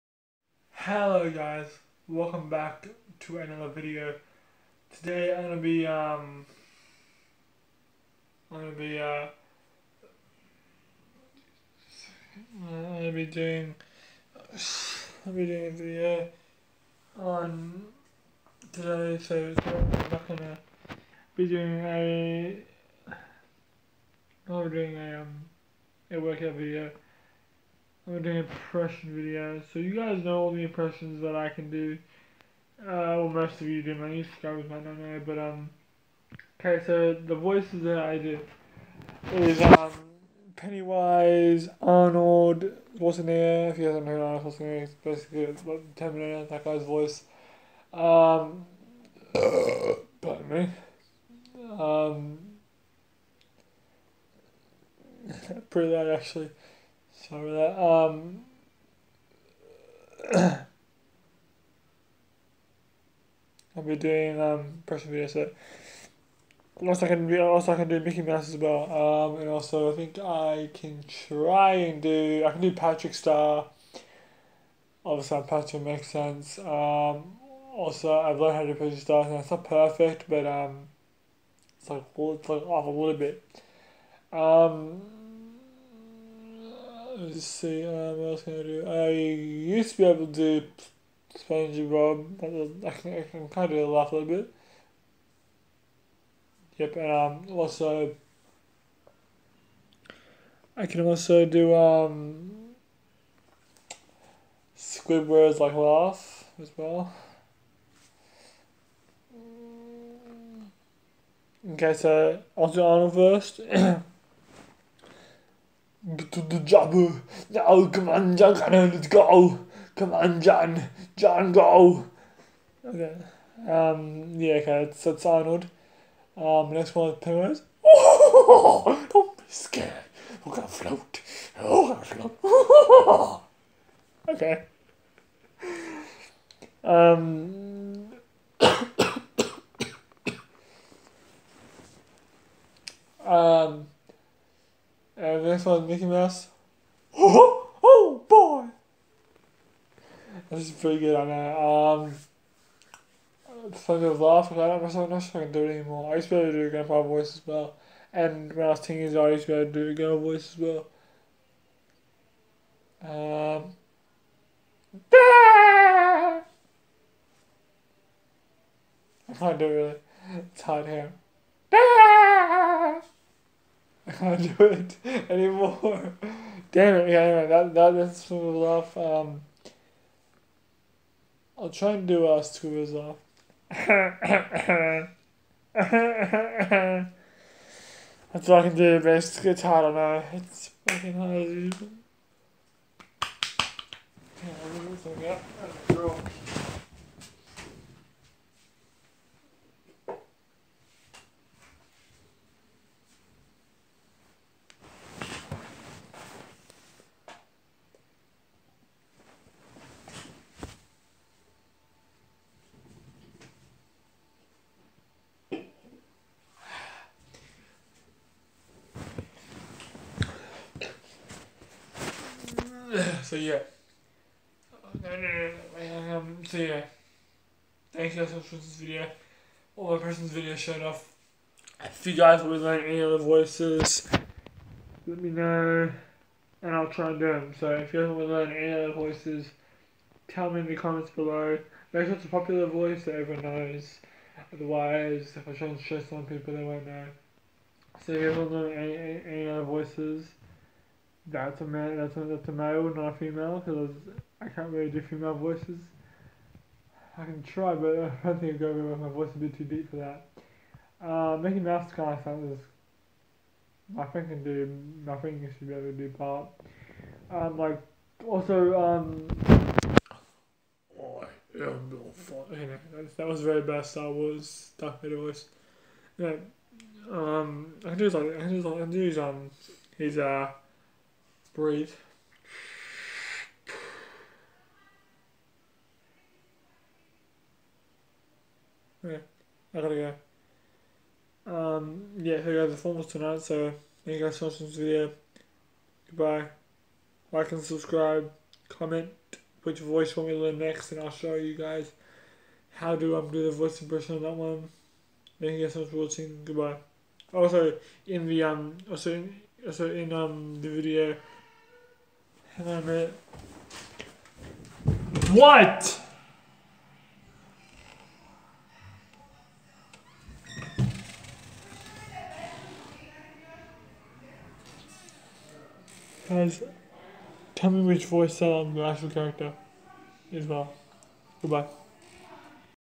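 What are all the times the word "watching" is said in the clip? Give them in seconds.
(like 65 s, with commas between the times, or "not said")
228 s, 294 s, 305 s.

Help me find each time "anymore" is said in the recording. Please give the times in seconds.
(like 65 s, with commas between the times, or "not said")
155 s, 175 s.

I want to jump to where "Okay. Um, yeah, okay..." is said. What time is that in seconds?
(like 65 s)
122 s.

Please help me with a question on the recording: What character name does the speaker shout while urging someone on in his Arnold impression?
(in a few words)
John Connor.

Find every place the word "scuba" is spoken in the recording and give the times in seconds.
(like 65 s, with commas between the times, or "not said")
182 s.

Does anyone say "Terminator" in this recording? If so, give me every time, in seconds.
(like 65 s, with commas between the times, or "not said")
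45 s.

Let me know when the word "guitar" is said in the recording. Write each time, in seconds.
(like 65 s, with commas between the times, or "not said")
189 s.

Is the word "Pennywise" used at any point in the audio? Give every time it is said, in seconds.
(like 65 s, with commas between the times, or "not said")
40 s, 127 s.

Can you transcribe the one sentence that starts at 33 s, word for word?
My subscribers might not know, but um, okay.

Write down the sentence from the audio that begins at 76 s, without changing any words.
Um, also I've learned how to Patrick Star, and it's not perfect, but um, it's like it's like off a little bit.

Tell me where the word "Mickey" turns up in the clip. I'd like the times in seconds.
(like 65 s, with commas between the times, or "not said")
67 s, 145 s, 261 s.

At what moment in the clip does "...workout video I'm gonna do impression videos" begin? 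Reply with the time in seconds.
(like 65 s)
26 s.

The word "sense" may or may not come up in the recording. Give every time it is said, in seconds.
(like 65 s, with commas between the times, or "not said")
76 s.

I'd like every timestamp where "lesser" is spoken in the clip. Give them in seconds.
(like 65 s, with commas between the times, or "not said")
not said.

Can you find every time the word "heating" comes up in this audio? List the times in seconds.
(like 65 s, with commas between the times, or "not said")
not said.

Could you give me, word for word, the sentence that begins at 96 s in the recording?
Yep, and um, also, I can also do um, Squidward's like laugh as well.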